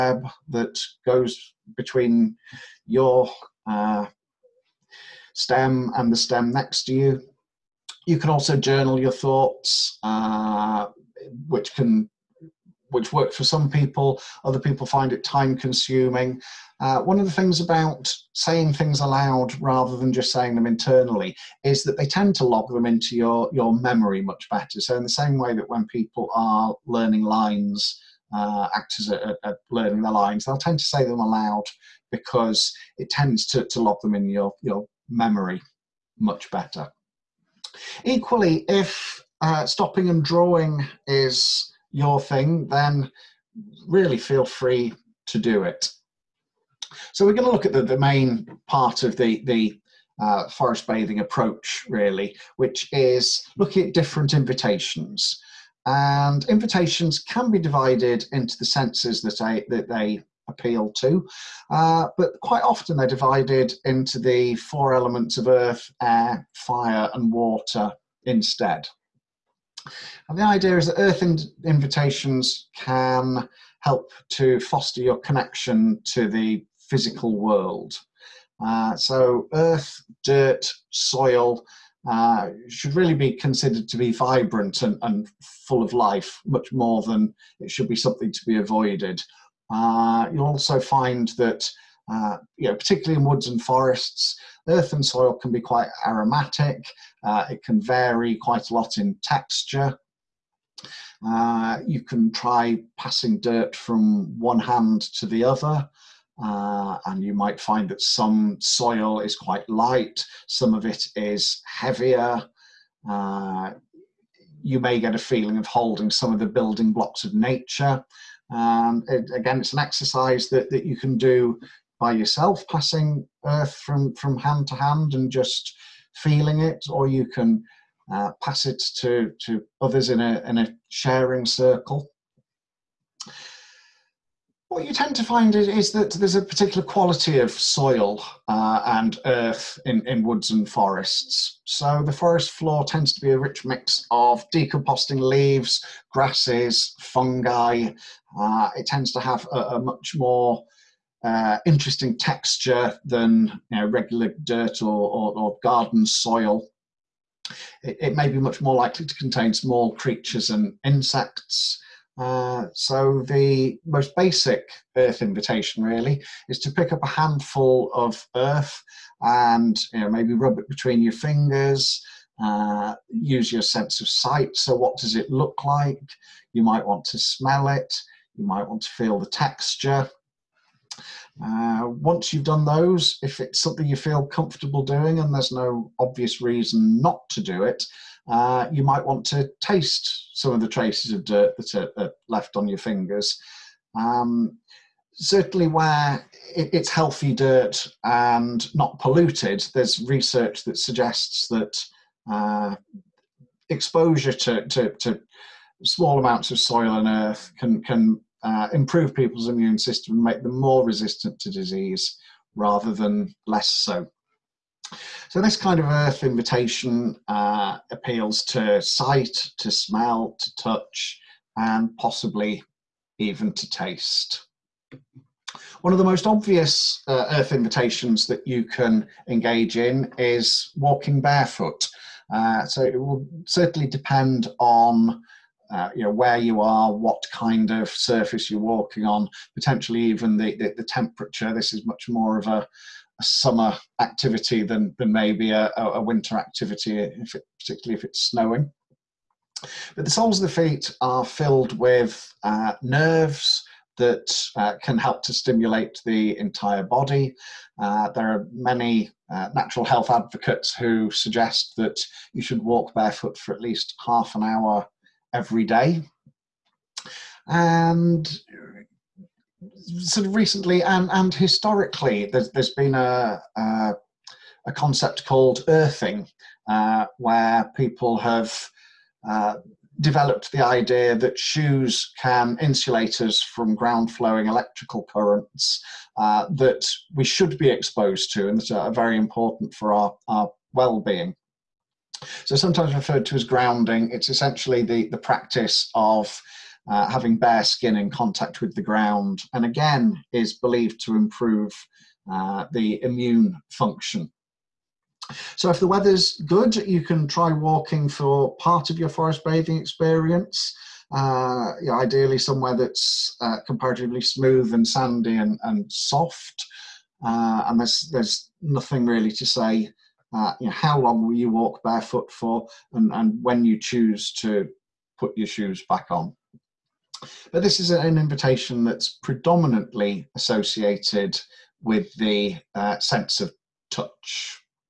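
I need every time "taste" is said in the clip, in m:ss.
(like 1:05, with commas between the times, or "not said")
3:09, 3:43.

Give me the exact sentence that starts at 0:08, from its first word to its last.
You can also journal your thoughts, uh, which can which works for some people.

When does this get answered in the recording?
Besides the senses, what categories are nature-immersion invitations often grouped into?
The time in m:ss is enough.
1:04.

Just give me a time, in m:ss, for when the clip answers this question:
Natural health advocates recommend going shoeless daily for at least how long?
4:24.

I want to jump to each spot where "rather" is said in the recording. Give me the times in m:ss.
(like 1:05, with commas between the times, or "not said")
0:19, 3:32.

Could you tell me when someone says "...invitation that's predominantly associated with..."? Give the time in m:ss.
5:28.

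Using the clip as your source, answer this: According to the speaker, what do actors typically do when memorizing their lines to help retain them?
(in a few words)
say them aloud.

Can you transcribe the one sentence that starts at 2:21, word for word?
So the forest floor tends to be a rich mix of decomposing leaves, grasses, fungi.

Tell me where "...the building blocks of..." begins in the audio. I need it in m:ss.
1:56.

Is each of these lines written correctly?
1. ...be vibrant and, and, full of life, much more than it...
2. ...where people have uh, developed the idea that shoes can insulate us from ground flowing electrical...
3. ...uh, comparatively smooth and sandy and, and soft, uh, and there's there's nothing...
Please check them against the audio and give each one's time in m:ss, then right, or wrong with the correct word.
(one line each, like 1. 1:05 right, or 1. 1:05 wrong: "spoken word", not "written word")
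1. 1:23 right
2. 4:37 right
3. 5:13 right.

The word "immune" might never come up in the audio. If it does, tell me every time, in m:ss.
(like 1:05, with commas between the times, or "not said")
3:29, 5:03.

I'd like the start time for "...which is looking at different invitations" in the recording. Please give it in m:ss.
0:52.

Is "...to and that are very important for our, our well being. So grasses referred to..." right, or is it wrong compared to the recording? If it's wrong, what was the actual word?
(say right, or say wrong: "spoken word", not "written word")
wrong: "sometimes", not "grasses".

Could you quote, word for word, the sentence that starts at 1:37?
Uh, it can vary quite a lot in texture.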